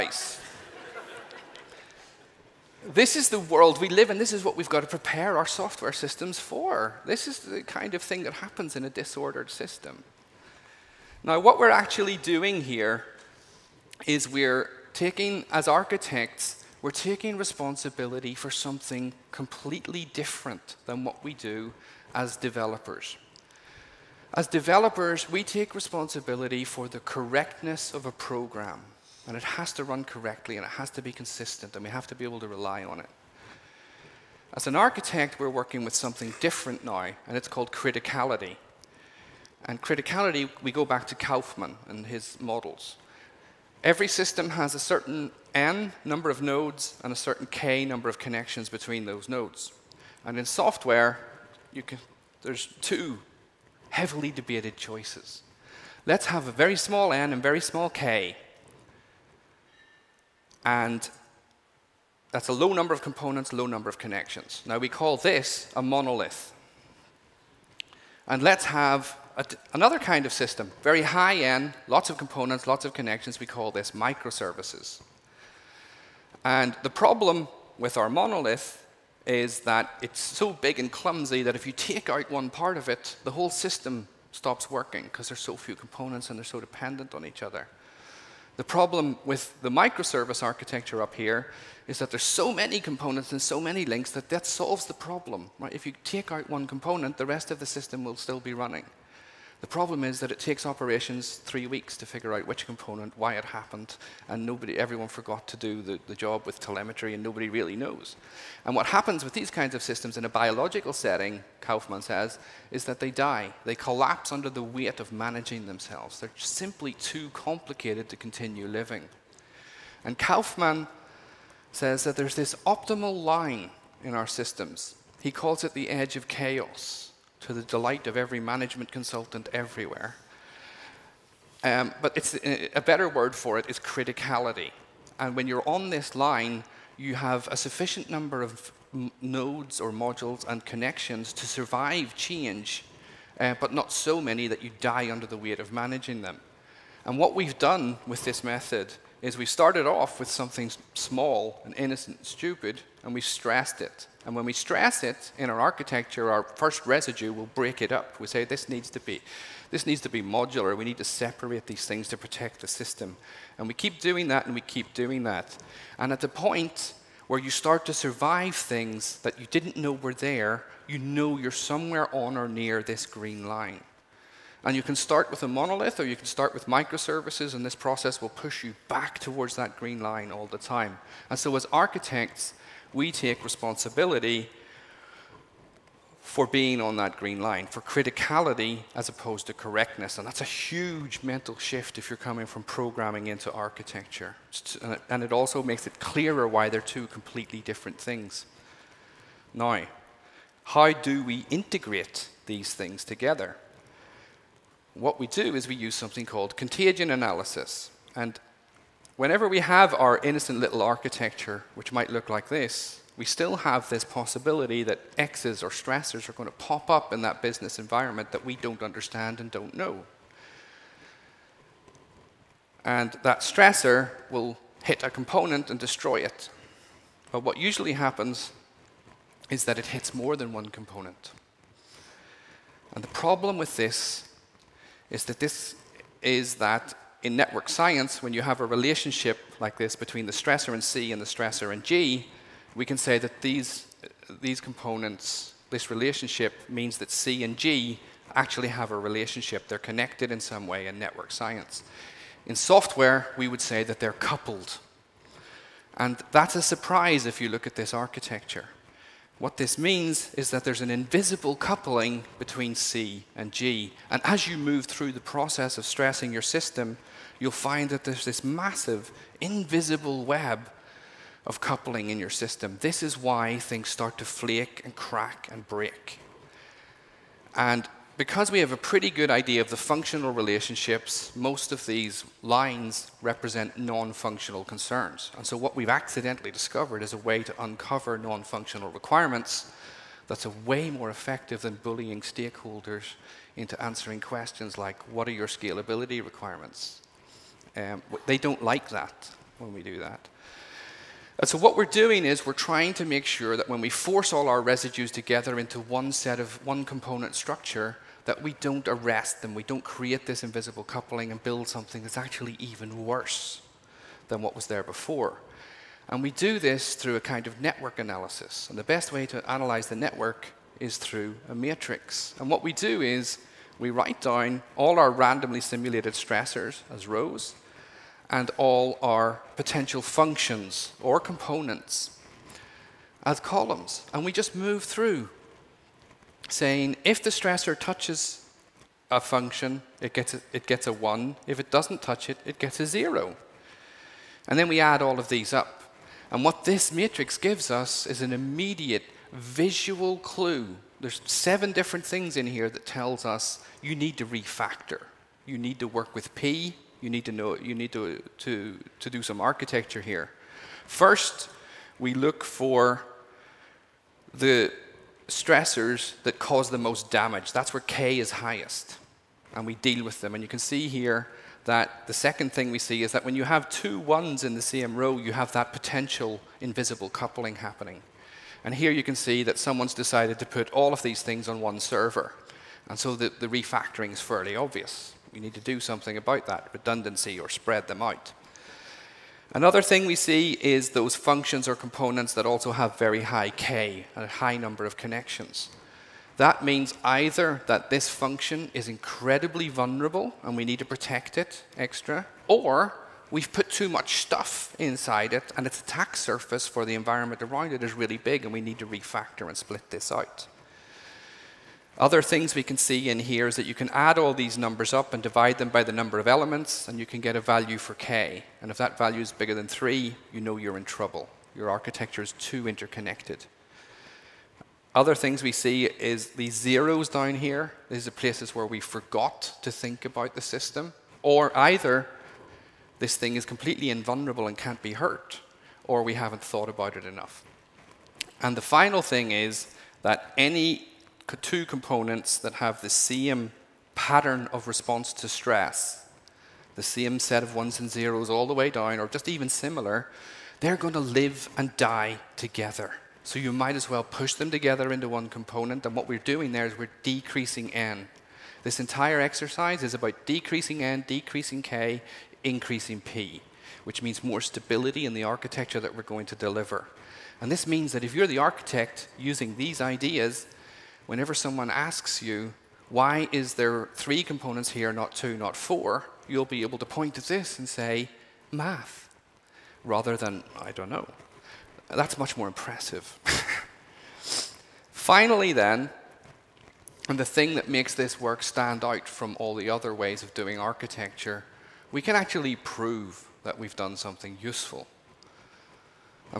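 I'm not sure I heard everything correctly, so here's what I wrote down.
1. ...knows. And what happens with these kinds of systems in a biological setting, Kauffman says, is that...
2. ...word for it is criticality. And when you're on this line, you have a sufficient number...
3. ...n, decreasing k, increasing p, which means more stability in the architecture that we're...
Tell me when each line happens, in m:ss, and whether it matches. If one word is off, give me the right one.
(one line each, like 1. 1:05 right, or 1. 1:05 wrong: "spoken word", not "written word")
1. 1:47 right
2. 2:13 right
3. 7:40 right.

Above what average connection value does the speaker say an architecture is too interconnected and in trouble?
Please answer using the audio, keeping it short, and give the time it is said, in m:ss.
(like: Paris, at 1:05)
3, at 6:59.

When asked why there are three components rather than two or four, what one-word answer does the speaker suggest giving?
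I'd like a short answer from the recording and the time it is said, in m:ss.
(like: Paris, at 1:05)
math, at 7:58.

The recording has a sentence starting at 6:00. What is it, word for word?
First, we look for the stressors that cause the most damage.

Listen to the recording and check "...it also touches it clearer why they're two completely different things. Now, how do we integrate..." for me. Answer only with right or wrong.
wrong.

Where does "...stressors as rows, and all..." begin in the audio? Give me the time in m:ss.
5:26.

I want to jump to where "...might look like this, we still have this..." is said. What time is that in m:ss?
3:31.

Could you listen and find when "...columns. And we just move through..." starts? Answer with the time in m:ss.
5:33.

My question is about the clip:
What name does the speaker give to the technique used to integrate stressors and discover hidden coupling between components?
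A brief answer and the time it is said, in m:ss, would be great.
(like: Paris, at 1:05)
contagion analysis, at 3:26.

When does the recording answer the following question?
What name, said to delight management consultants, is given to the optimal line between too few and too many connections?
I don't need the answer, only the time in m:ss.
2:05.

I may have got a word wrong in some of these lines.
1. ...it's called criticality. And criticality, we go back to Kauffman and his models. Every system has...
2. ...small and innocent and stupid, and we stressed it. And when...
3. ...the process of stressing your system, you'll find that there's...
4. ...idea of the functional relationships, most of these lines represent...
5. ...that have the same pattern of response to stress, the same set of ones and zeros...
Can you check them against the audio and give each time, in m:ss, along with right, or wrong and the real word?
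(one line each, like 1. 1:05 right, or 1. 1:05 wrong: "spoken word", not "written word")
1. 0:37 right
2. 2:30 right
3. 4:25 right
4. 4:39 right
5. 7:22 right.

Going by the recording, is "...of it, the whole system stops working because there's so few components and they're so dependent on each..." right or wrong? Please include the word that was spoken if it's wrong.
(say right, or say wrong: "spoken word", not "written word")
right.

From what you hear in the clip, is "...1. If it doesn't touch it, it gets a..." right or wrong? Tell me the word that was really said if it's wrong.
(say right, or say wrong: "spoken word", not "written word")
right.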